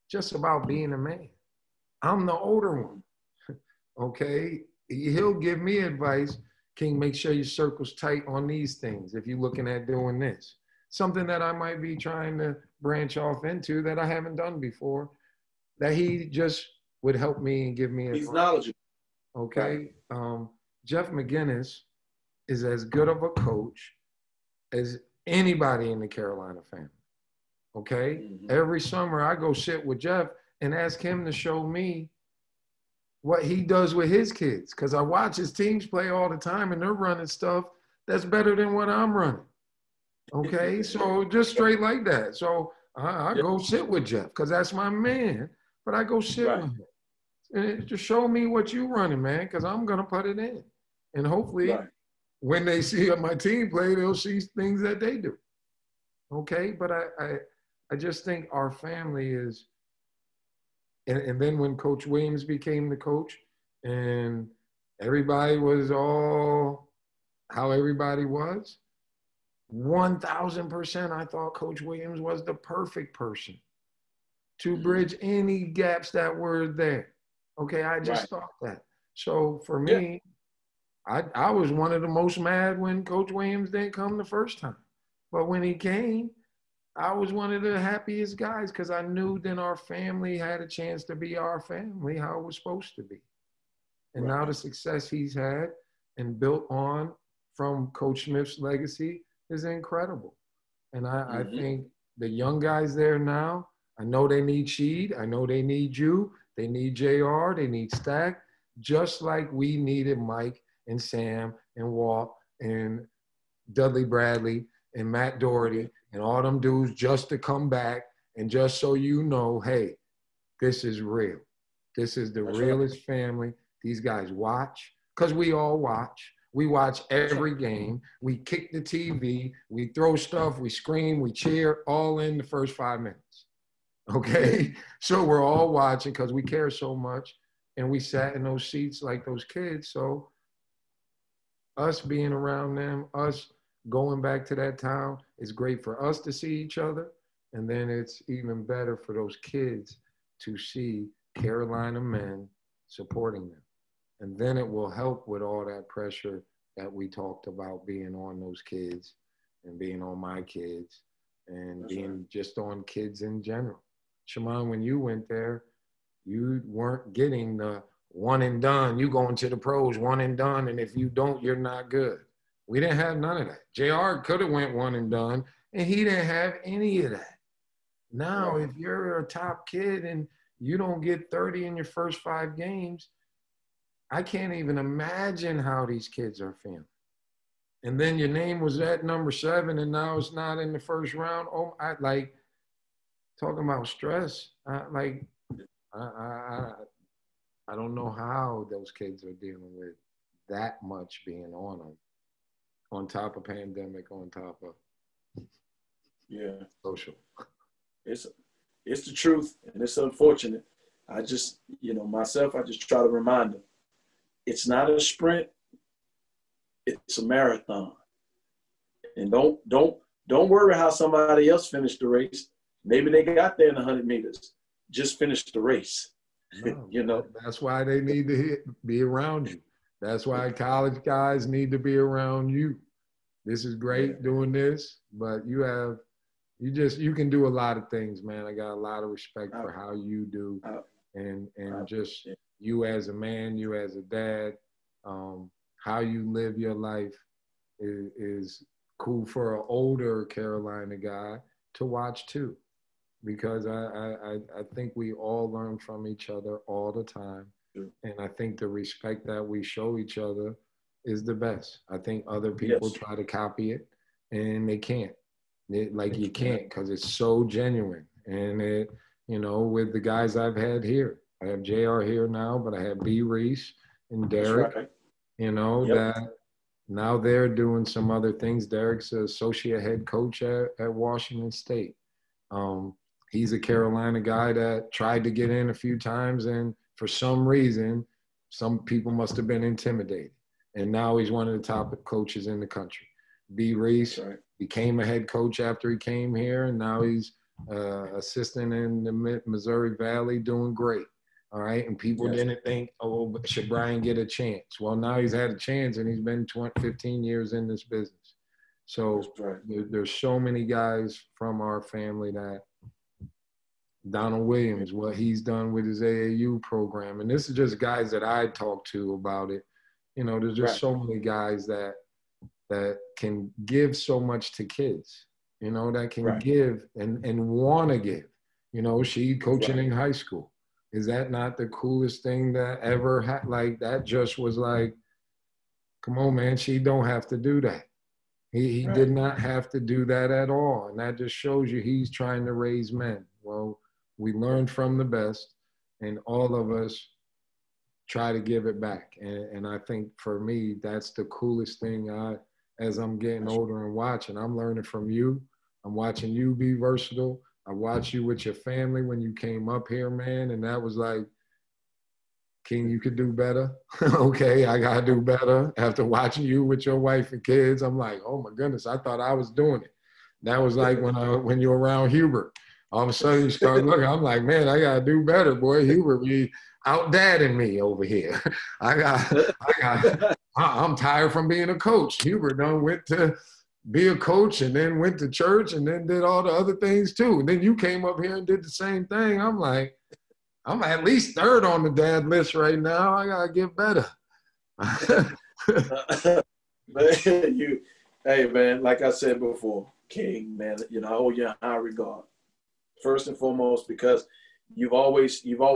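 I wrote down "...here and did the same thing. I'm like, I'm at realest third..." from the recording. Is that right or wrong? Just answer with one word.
wrong.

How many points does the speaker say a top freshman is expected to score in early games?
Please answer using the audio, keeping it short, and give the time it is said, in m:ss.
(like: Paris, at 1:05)
30, at 3:01.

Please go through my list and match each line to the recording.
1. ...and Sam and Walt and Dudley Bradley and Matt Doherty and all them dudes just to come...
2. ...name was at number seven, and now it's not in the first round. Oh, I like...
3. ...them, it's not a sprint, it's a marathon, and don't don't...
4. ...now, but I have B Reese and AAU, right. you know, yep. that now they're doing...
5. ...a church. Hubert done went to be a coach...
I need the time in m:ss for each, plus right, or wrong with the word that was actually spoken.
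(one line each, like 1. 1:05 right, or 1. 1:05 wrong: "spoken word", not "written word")
1. 1:50 right
2. 3:08 right
3. 3:33 right
4. 4:32 wrong: "Derek", not "AAU"
5. 6:21 wrong: "coach", not "church".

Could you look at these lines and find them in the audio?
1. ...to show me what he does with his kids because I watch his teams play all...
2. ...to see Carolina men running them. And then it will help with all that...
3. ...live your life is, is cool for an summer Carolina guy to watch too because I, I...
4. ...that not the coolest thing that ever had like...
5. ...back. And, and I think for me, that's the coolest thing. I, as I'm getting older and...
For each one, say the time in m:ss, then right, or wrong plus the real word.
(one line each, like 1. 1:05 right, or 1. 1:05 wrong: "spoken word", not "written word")
1. 0:31 right
2. 2:30 wrong: "supporting", not "running"
3. 4:06 wrong: "older", not "summer"
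4. 5:31 right
5. 5:48 right.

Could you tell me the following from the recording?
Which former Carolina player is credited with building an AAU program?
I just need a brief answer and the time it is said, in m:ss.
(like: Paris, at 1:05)
Donald Williams, at 5:14.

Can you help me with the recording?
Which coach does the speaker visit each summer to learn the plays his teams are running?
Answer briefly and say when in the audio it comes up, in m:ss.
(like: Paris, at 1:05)
Jeff McInnis, at 0:20.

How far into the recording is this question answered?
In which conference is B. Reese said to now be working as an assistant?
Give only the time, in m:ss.
4:59.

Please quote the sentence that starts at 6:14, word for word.
I'm like, man, I gotta do better, boy.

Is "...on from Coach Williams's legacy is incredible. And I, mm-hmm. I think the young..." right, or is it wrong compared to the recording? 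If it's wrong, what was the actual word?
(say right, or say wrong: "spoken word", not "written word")
wrong: "Smith", not "Williams".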